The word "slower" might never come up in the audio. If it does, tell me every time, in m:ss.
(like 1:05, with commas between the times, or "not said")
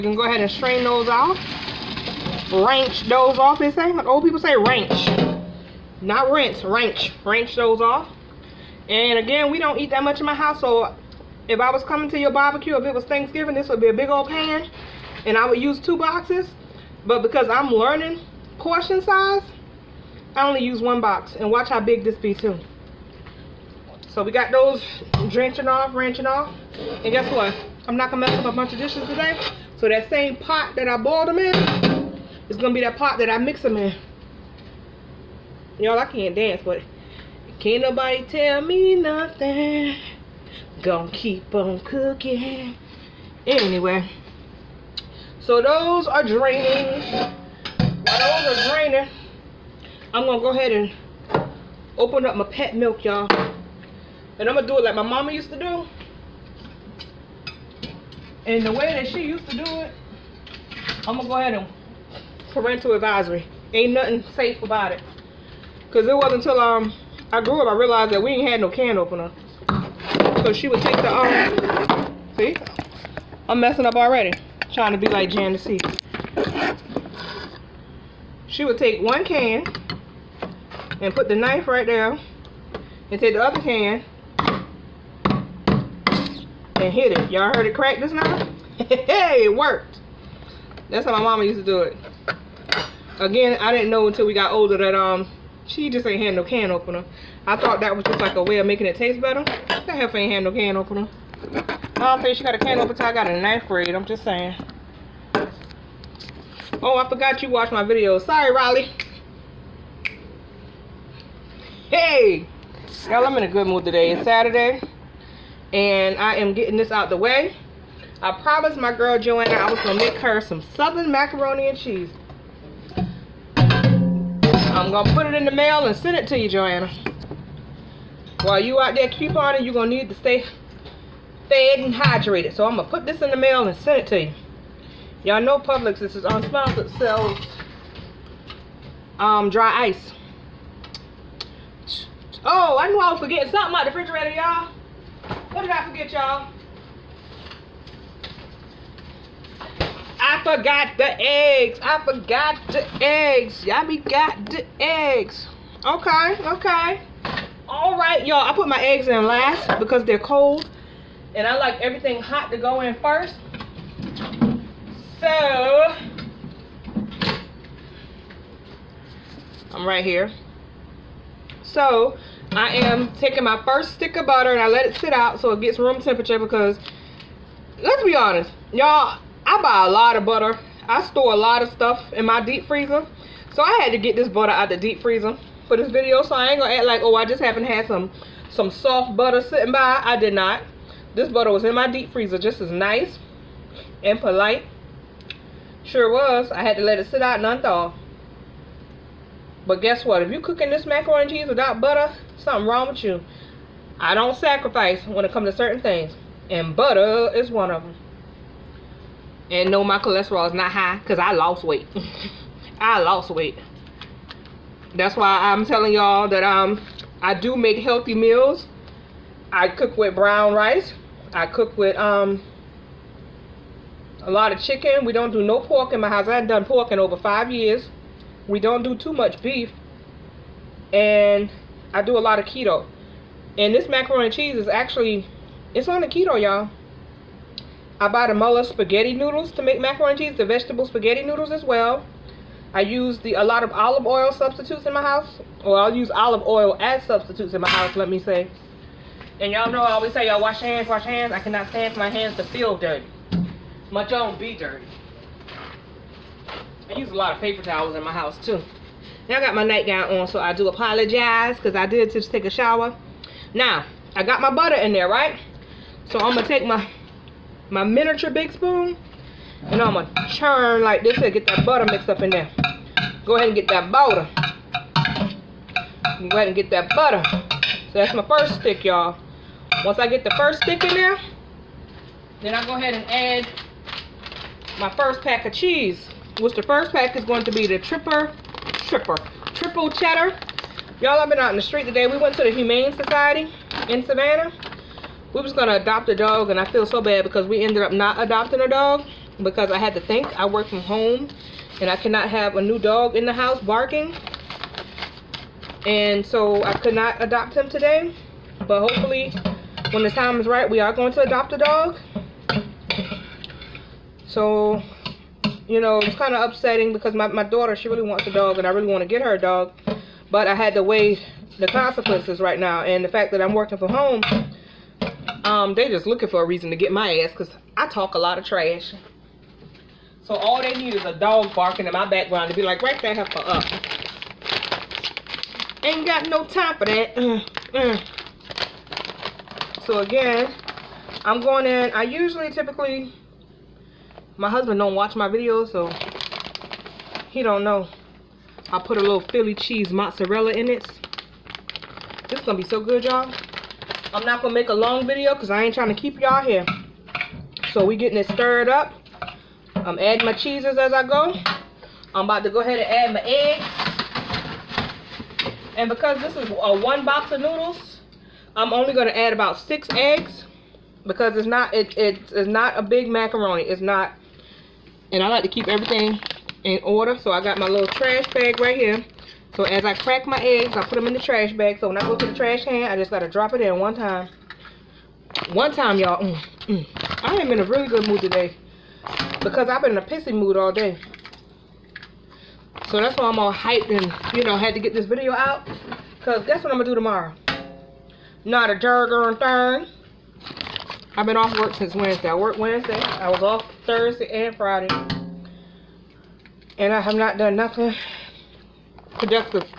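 not said.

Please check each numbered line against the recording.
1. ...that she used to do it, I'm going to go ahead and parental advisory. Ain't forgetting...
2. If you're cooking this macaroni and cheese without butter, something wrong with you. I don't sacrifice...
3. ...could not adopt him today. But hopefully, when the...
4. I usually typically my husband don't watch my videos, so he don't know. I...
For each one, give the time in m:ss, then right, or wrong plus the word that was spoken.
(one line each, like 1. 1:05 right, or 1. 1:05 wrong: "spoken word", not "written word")
1. 0:58 wrong: "nothing", not "forgetting"
2. 3:20 right
3. 5:06 right
4. 5:41 right.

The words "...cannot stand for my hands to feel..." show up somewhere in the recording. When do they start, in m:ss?
4:11.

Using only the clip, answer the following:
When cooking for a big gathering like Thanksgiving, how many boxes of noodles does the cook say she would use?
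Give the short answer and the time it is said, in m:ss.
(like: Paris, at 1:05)
2, at 0:15.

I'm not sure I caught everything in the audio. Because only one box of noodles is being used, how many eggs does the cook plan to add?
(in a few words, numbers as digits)
6.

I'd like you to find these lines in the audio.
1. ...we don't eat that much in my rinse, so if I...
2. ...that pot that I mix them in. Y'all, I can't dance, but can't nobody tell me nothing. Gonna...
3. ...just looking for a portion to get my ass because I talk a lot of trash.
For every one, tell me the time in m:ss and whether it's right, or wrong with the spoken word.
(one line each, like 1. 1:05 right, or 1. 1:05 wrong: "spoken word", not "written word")
1. 0:09 wrong: "house", not "rinse"
2. 0:32 right
3. 5:25 wrong: "reason", not "portion".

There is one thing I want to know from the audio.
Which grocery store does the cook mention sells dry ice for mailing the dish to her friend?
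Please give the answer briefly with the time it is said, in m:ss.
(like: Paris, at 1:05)
Publix, at 2:15.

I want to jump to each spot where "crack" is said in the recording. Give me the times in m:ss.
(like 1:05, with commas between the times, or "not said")
1:27, 6:19.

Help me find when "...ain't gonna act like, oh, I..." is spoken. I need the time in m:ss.
3:06.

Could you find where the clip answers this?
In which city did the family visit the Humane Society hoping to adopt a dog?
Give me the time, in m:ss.
4:54.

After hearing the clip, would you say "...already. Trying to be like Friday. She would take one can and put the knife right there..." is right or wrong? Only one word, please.
wrong.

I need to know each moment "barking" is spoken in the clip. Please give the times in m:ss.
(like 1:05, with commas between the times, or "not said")
5:03, 5:31.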